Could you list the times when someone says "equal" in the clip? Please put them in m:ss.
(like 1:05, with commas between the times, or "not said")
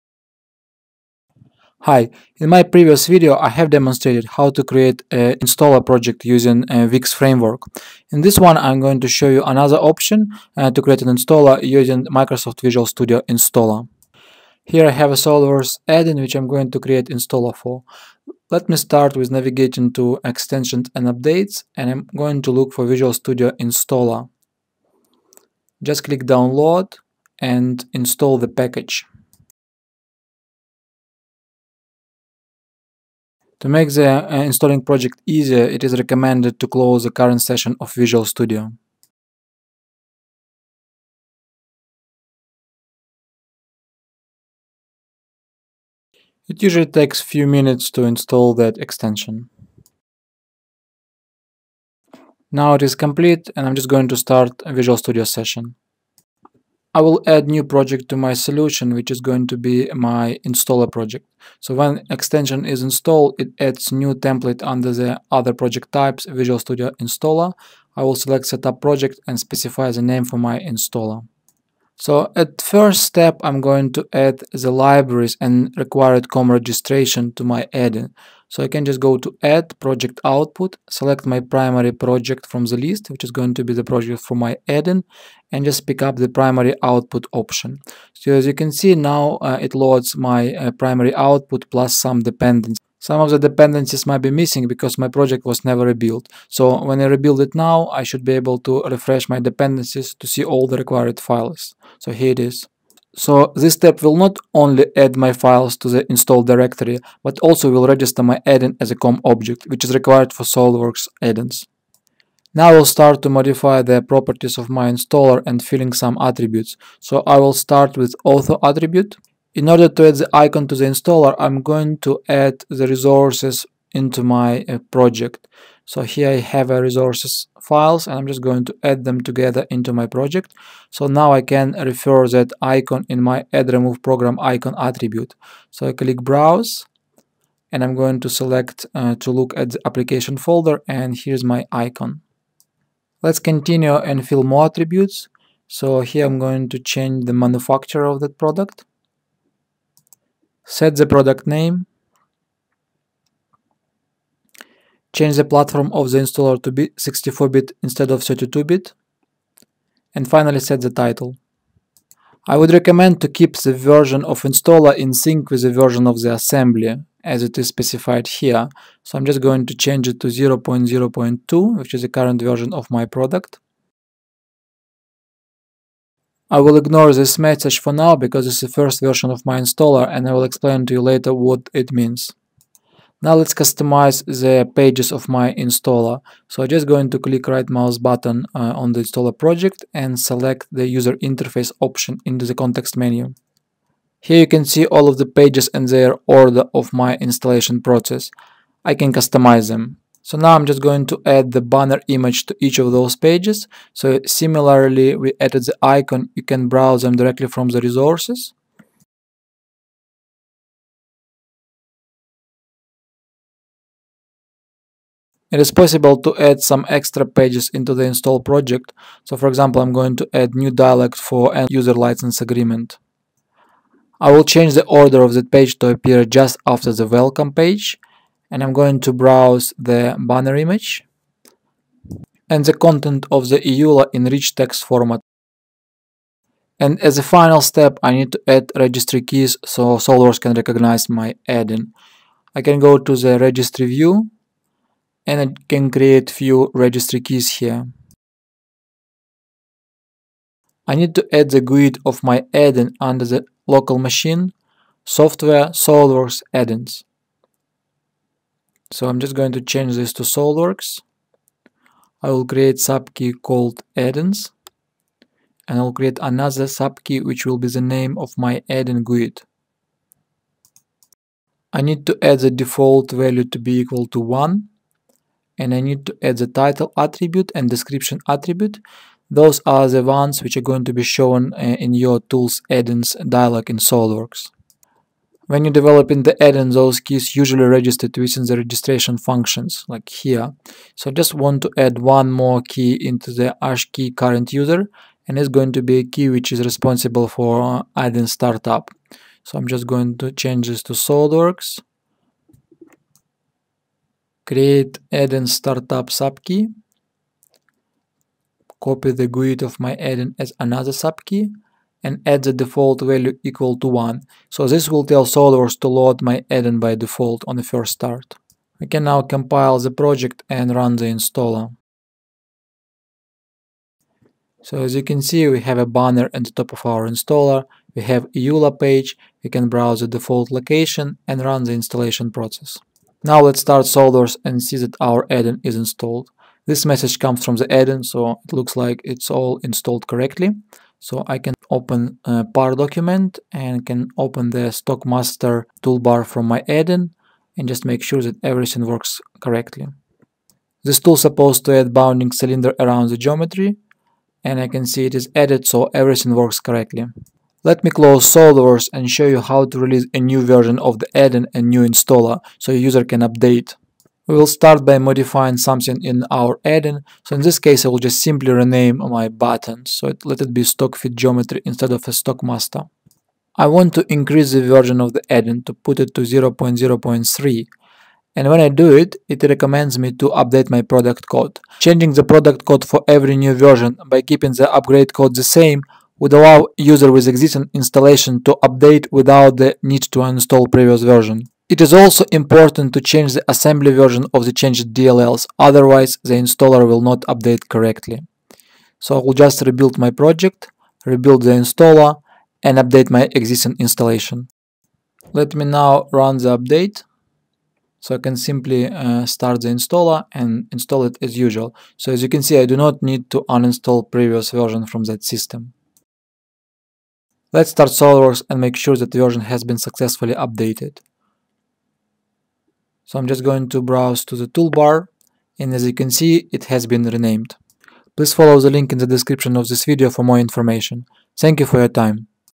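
4:33, 5:13.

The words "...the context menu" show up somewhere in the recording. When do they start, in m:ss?
3:12.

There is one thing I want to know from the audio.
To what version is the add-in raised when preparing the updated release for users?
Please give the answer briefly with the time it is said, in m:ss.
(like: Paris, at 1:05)
0.0.3, at 6:16.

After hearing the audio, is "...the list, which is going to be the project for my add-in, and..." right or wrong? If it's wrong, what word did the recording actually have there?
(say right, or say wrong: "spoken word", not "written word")
right.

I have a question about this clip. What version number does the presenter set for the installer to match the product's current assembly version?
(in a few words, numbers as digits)
0.0.2.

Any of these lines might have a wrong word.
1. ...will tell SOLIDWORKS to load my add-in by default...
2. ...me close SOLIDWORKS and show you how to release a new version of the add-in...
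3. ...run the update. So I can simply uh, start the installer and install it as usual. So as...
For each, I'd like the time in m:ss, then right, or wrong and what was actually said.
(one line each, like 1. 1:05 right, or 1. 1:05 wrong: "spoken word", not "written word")
1. 5:14 right
2. 5:57 right
3. 6:46 right.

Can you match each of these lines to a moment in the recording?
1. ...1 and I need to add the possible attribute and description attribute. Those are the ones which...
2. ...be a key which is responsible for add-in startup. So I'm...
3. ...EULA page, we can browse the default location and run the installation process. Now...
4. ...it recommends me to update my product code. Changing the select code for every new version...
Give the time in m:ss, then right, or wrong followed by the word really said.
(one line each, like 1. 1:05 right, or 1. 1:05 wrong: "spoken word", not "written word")
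1. 4:34 wrong: "title", not "possible"
2. 4:55 right
3. 5:28 right
4. 6:19 wrong: "product", not "select".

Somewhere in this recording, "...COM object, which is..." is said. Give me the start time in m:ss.
1:48.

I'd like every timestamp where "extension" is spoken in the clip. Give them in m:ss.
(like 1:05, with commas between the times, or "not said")
0:20, 0:48, 1:02.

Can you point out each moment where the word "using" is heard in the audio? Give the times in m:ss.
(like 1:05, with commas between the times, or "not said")
0:06, 0:11.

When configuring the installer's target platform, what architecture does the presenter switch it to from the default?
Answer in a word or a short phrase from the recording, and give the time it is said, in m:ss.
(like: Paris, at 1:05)
64-bit, at 2:36.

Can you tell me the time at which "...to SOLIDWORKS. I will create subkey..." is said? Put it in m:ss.
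4:20.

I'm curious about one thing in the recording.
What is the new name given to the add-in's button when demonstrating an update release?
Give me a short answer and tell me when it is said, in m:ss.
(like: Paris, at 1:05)
stock fit geometry, at 6:10.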